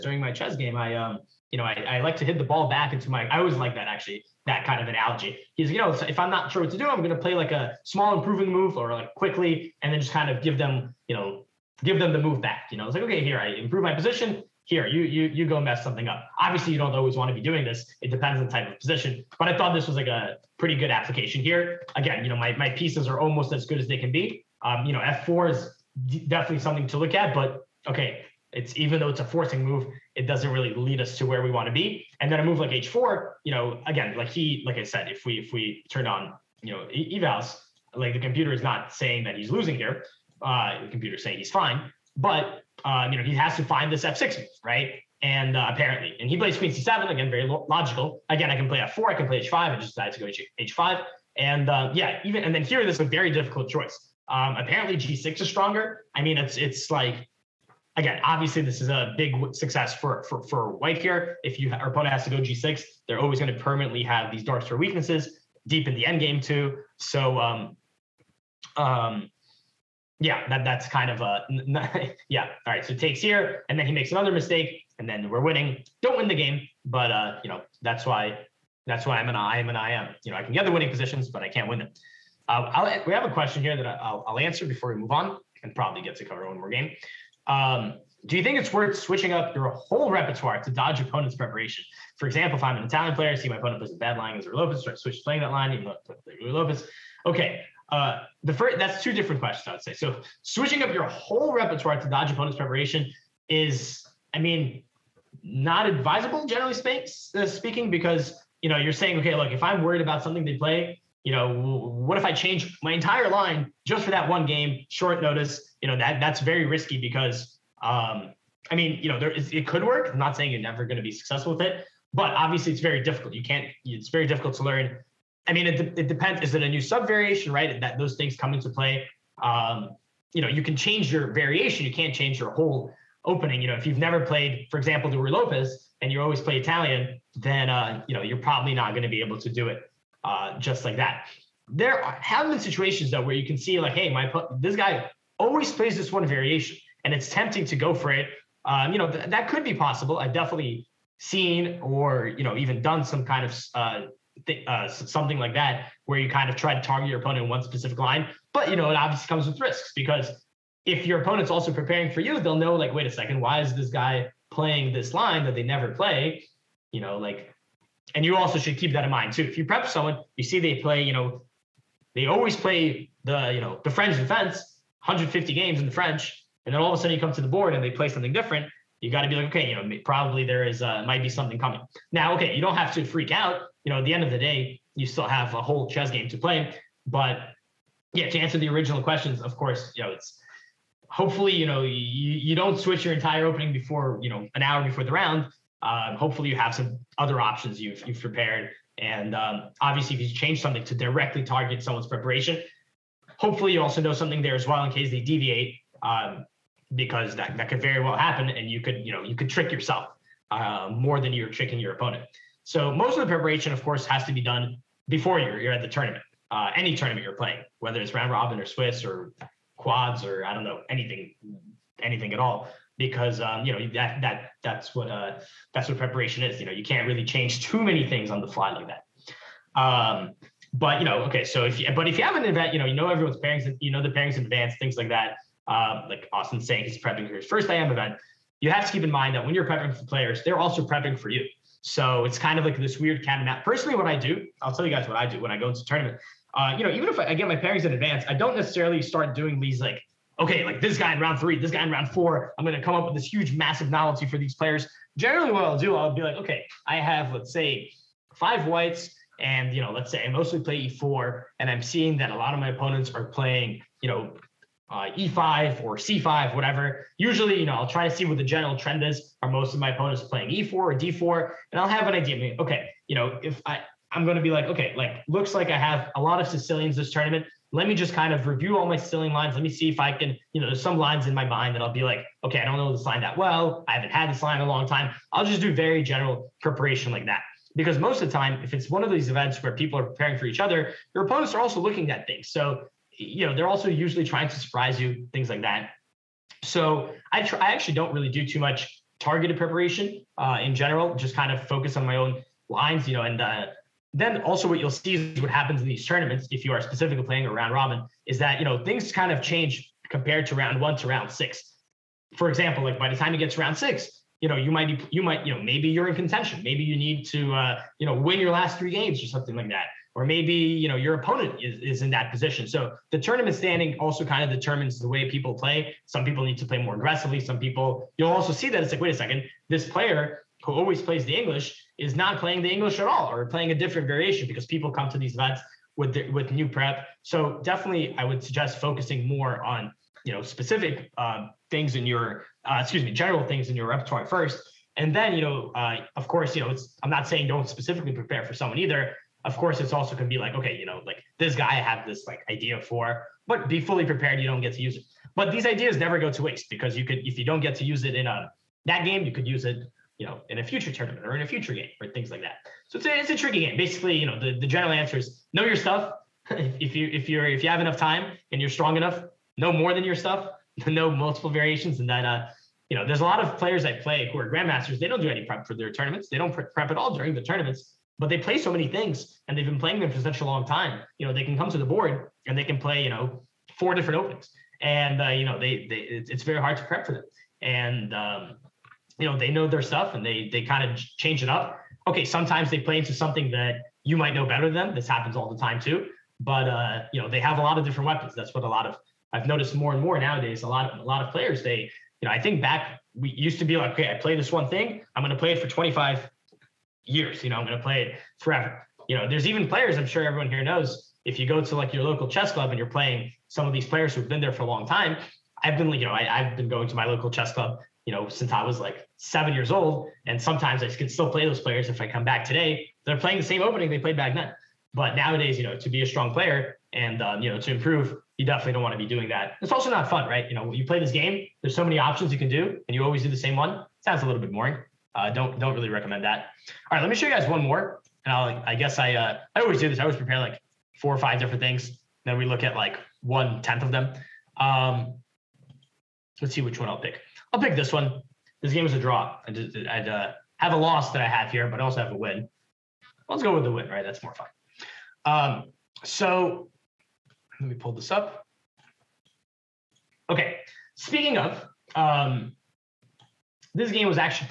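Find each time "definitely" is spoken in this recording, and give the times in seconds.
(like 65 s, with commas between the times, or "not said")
26 s, 150 s, 337 s, 428 s.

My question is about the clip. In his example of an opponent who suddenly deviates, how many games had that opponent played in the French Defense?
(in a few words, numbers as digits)
150.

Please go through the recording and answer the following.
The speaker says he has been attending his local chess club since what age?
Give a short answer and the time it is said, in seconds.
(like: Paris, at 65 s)
7, at 419 s.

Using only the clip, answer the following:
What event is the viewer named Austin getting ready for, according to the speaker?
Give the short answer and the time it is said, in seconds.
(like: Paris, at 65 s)
His first IM event, at 237 s.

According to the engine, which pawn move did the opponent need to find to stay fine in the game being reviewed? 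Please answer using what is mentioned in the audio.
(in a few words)
f6.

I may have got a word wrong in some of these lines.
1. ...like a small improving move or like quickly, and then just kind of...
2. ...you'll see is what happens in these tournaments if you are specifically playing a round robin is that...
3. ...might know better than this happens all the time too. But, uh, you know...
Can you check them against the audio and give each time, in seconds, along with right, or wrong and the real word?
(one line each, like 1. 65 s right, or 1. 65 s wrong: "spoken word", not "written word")
1. 7 s right
2. 304 s right
3. 394 s right.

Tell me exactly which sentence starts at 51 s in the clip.
And uh, yeah, even and then here, this is a very difficult choice.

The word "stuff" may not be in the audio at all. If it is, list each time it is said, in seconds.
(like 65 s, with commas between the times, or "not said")
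365 s, 370 s, 389 s.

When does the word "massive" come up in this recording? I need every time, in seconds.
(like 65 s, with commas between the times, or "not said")
253 s.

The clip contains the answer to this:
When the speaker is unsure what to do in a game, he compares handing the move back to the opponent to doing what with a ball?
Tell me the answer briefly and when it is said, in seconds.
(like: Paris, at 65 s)
Hit the ball back, at 2 s.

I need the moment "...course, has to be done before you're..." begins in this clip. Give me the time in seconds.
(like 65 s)
213 s.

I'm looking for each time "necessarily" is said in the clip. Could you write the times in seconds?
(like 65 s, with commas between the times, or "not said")
248 s.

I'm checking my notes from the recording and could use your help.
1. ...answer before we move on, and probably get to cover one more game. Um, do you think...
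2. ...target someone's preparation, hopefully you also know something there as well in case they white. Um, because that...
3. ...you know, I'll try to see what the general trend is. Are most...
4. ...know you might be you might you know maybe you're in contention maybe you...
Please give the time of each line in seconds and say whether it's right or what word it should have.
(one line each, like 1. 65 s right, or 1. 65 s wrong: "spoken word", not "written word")
1. 84 s right
2. 201 s wrong: "deviate", not "white"
3. 267 s right
4. 314 s right.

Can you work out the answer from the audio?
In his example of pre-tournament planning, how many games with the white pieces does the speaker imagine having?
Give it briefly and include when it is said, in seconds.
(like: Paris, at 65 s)
5, at 258 s.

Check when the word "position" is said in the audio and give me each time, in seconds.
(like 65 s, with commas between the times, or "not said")
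13 s, 18 s, 80 s, 322 s.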